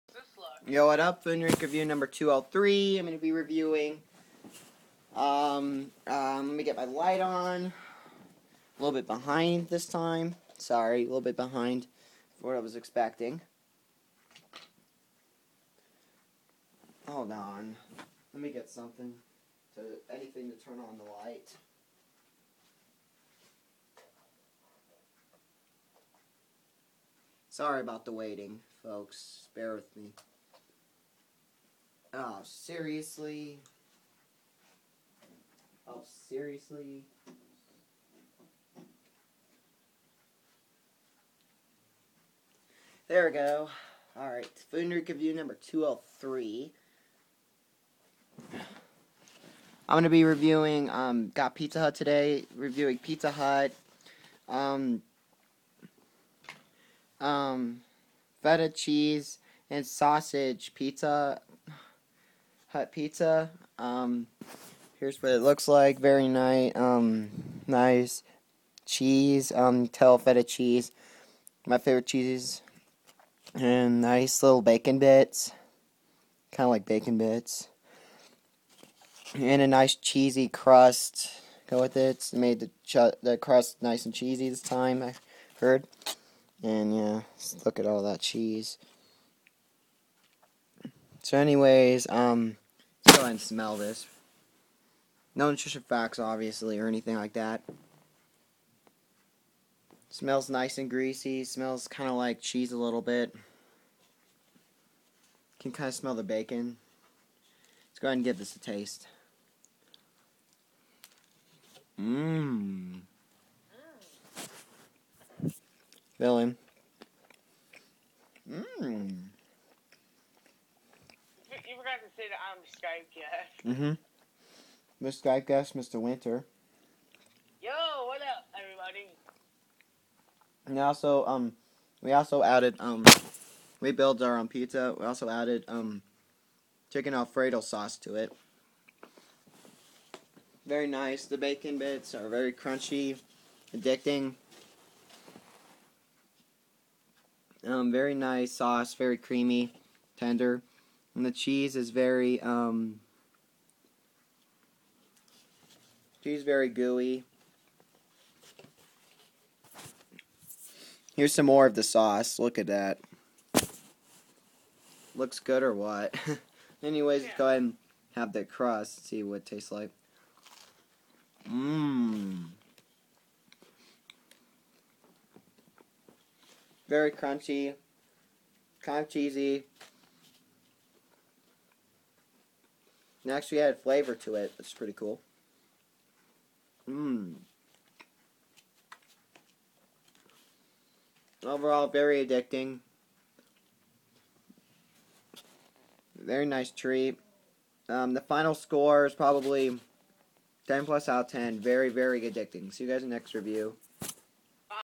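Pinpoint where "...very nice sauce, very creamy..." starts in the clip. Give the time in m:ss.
2:27.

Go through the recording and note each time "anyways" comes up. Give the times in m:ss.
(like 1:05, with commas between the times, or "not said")
1:31, 2:46.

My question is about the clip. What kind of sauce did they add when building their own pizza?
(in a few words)
chicken alfredo sauce.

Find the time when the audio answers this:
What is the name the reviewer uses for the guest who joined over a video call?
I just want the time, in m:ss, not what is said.
2:05.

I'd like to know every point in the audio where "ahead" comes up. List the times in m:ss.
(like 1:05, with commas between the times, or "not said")
1:33, 1:48, 2:47.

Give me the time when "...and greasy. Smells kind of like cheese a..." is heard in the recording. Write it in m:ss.
1:40.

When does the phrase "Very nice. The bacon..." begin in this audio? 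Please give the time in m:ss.
2:20.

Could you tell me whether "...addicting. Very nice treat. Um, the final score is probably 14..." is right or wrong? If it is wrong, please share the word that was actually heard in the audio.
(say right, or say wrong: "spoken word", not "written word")
wrong: "10", not "14".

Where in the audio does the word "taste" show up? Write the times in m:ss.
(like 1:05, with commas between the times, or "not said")
1:48, 2:49.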